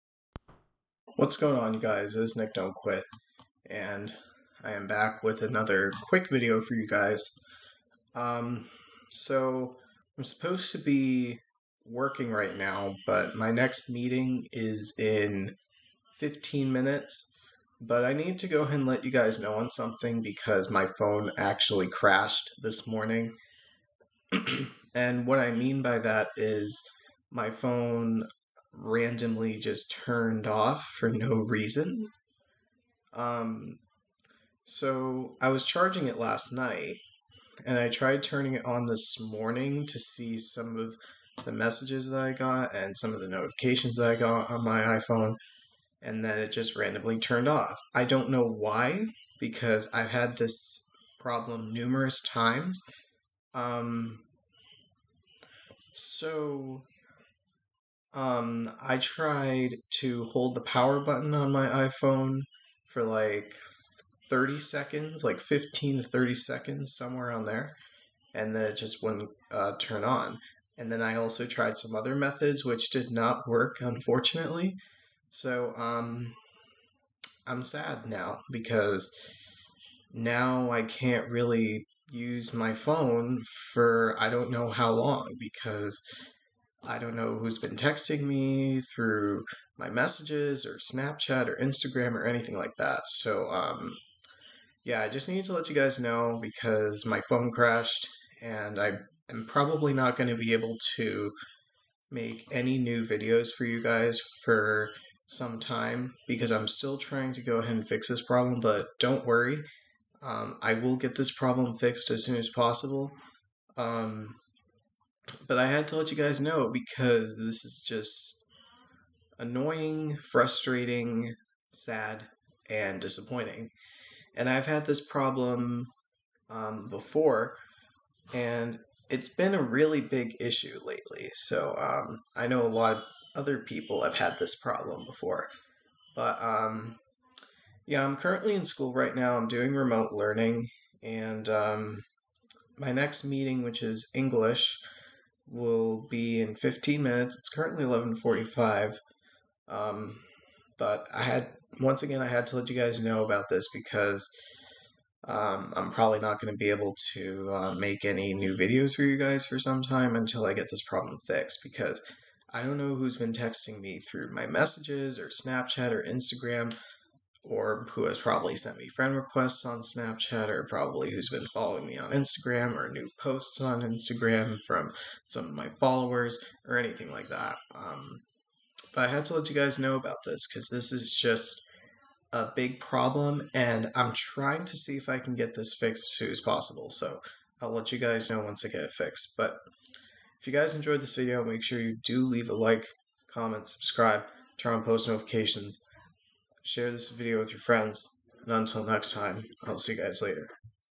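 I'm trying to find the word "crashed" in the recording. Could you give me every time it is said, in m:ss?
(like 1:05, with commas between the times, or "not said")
0:21, 1:37.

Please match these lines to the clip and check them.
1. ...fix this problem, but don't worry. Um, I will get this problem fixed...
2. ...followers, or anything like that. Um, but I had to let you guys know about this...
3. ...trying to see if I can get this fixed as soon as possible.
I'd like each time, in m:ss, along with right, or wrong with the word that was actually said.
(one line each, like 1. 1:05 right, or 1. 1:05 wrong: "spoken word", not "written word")
1. 1:47 right
2. 2:55 right
3. 3:04 right.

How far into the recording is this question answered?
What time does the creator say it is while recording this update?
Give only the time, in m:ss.
2:27.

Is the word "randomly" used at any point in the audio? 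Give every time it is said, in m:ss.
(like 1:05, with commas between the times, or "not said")
0:28, 0:46.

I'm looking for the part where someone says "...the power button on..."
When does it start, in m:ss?
1:00.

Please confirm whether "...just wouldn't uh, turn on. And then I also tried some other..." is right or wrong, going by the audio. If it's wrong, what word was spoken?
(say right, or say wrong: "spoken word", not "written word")
right.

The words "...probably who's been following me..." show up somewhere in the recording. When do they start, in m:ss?
2:50.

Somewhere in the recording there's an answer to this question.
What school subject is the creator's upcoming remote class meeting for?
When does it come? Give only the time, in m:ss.
2:24.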